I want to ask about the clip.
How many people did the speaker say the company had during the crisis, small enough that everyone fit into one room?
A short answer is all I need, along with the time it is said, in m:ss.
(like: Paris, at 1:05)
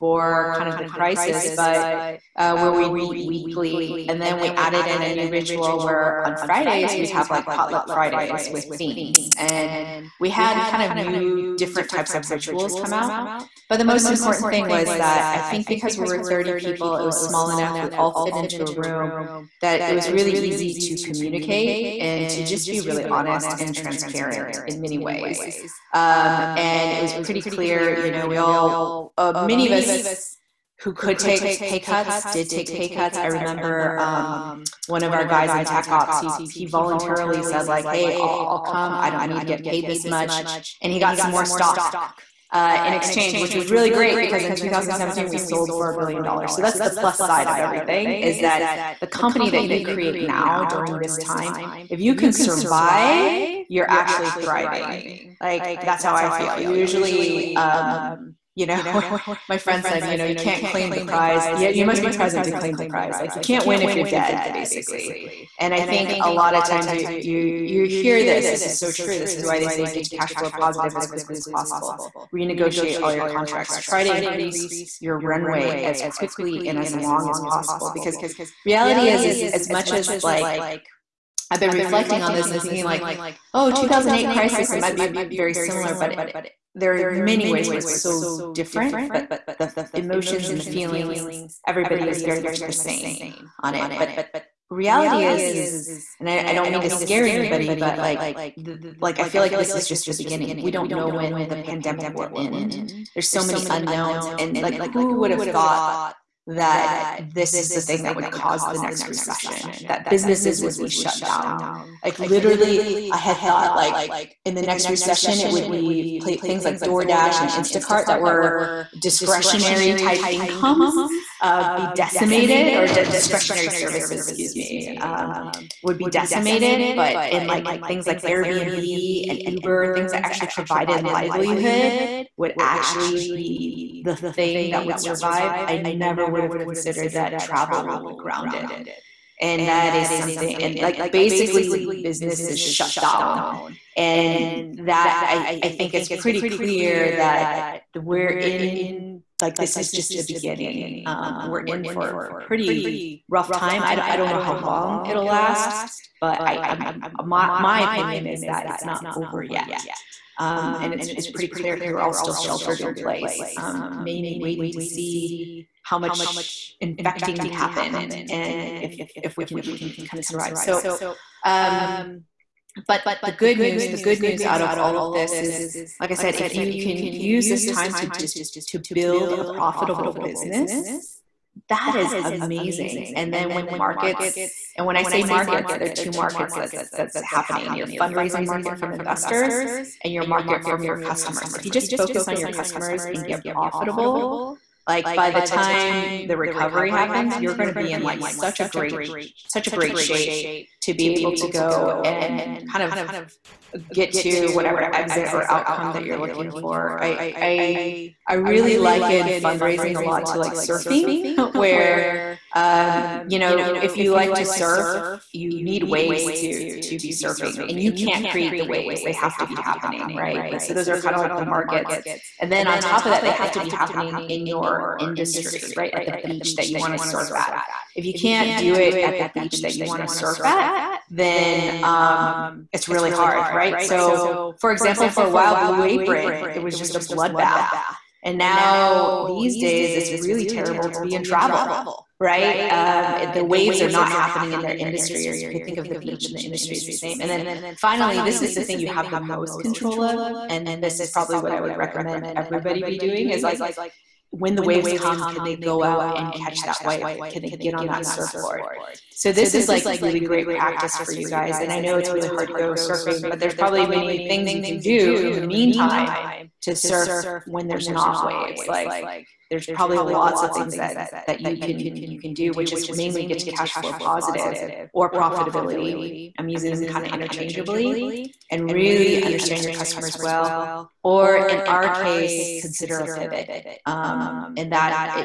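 30, at 0:16.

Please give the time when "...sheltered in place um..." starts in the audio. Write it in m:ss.
2:42.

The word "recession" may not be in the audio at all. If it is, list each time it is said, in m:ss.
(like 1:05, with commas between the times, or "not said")
1:49, 1:54.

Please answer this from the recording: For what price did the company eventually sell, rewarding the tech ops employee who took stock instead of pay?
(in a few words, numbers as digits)
$1 billion.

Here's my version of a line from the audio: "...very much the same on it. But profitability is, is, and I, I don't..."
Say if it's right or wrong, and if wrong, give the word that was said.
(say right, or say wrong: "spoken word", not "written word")
wrong: "reality", not "profitability".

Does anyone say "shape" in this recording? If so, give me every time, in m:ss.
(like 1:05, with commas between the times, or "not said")
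3:19.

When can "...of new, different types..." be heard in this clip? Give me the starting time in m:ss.
0:10.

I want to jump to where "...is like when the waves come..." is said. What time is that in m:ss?
4:13.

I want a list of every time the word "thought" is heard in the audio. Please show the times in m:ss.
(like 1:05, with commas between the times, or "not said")
1:45, 1:53.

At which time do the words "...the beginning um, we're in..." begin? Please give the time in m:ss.
2:30.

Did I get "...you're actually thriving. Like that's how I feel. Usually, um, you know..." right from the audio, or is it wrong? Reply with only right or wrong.
right.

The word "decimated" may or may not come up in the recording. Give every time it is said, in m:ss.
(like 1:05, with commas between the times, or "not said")
2:01, 2:06.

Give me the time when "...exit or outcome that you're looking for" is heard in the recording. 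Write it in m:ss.
3:24.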